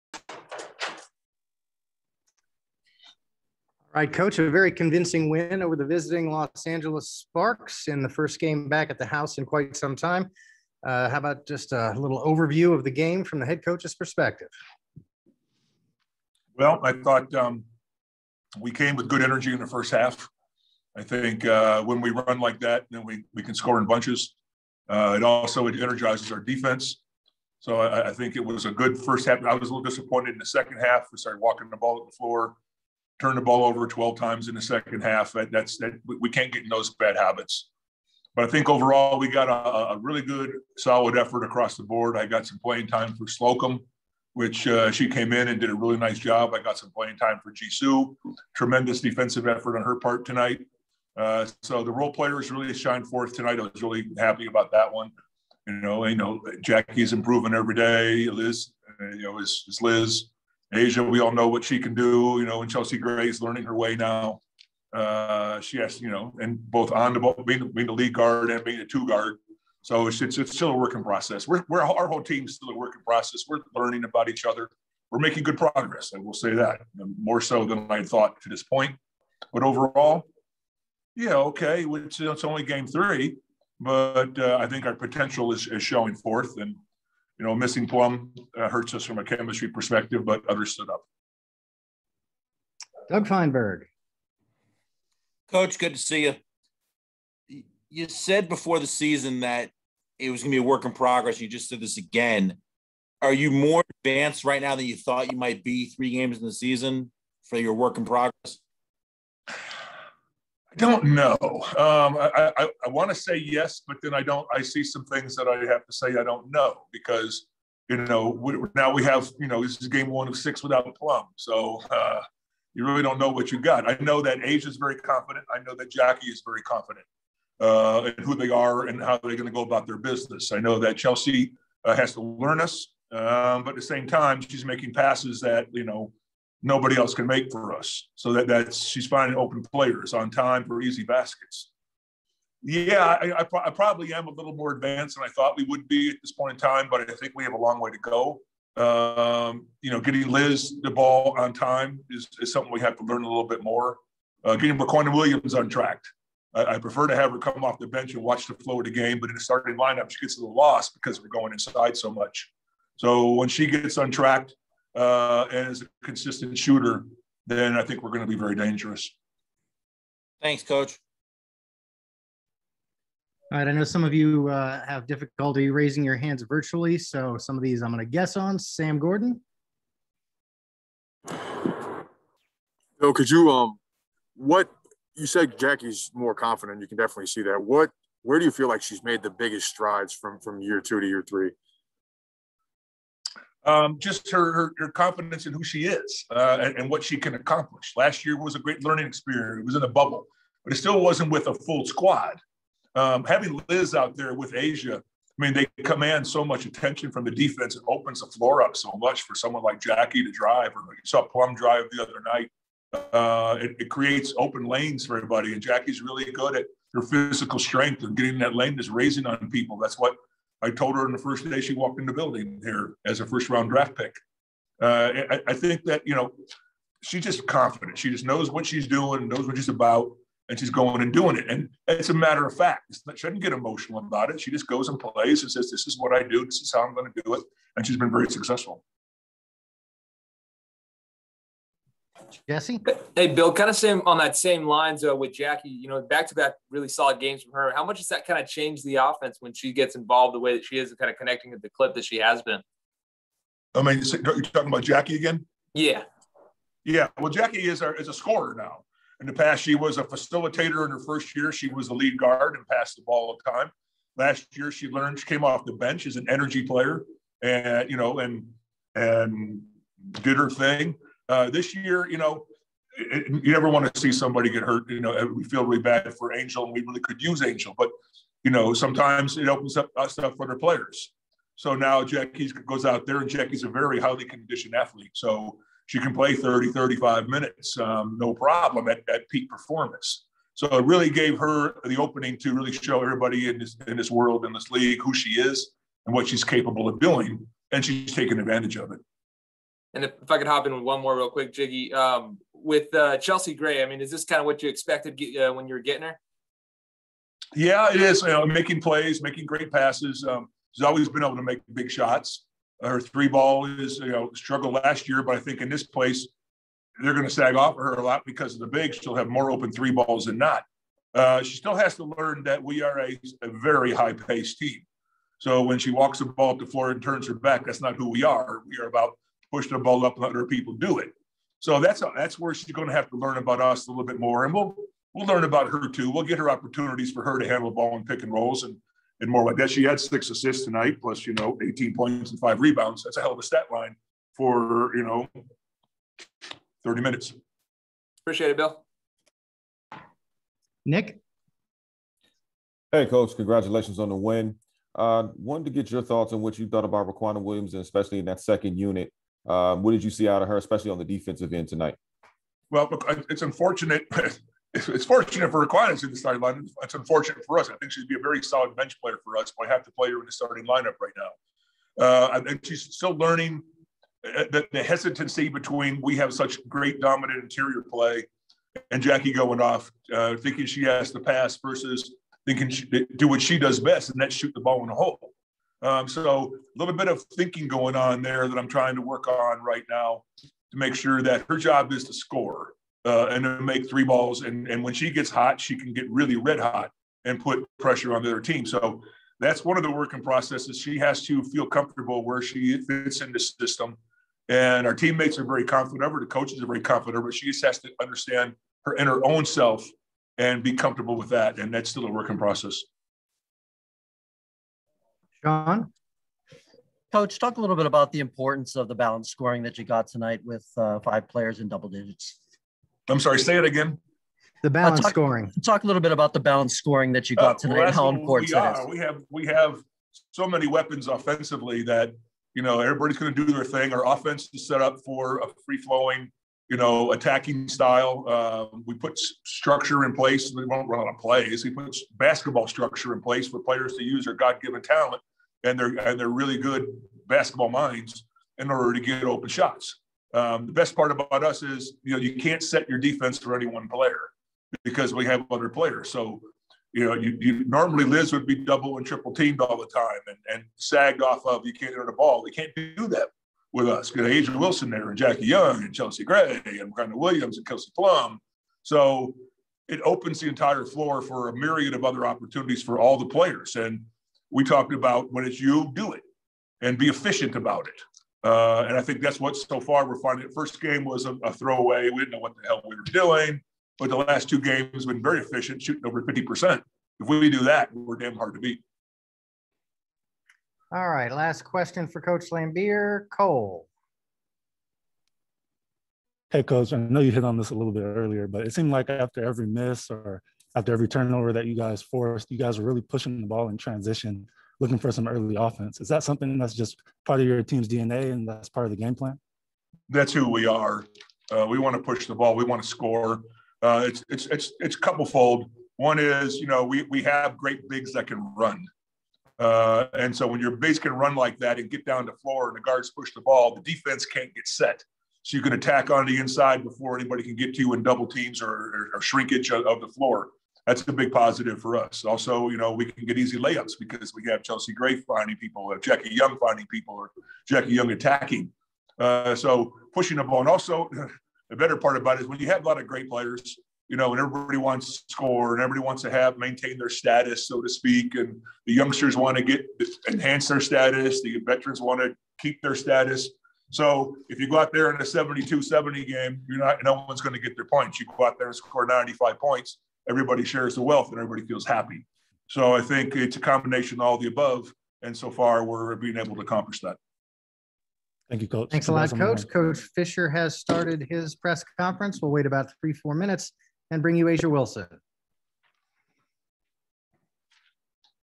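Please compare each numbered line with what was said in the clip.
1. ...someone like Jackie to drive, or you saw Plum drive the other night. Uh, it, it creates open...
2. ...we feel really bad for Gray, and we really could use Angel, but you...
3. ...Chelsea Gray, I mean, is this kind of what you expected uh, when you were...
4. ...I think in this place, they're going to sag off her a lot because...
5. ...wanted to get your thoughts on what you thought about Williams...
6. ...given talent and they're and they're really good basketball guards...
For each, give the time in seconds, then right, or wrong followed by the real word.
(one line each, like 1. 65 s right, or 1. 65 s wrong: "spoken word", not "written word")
1. 209 s right
2. 275 s wrong: "Angel", not "Gray"
3. 303 s right
4. 315 s right
5. 355 s wrong: "Riquna", not "Williams"
6. 444 s wrong: "minds", not "guards".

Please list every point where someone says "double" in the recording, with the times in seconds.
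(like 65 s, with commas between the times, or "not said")
421 s, 458 s, 528 s.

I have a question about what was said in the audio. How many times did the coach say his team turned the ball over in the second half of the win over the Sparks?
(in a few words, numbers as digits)
12.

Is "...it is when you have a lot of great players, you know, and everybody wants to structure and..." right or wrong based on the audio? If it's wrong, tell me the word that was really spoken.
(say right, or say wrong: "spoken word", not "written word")
wrong: "score", not "structure".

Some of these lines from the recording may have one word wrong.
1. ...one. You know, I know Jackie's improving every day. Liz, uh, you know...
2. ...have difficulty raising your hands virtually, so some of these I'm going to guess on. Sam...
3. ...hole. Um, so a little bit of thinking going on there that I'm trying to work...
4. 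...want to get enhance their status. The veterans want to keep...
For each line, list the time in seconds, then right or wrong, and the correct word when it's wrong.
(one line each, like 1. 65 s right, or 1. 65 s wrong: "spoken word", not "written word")
1. 54 s right
2. 174 s right
3. 384 s right
4. 549 s right.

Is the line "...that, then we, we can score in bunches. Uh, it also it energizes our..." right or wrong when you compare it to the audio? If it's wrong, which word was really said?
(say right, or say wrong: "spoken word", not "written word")
right.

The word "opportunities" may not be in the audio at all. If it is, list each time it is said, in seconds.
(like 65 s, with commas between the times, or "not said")
336 s, 472 s.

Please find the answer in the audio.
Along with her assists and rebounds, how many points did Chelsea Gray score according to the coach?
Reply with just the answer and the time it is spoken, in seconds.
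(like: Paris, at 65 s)
18, at 341 s.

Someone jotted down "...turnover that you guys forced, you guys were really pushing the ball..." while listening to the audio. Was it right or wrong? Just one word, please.
right.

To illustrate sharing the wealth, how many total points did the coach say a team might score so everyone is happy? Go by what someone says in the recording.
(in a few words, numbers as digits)
95.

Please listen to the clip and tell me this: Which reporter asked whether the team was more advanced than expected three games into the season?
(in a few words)
Doug Feinberg.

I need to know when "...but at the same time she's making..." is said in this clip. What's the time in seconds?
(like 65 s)
133 s.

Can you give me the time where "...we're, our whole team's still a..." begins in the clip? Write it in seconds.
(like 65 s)
71 s.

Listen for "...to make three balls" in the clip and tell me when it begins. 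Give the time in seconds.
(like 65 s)
393 s.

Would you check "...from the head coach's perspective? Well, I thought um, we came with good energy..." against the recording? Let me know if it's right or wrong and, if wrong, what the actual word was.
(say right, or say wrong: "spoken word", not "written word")
right.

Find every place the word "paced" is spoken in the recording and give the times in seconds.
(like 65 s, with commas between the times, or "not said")
324 s.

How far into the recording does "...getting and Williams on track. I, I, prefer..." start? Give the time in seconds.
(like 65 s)
154 s.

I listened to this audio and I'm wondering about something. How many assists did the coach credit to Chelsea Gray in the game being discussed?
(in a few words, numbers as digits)
6.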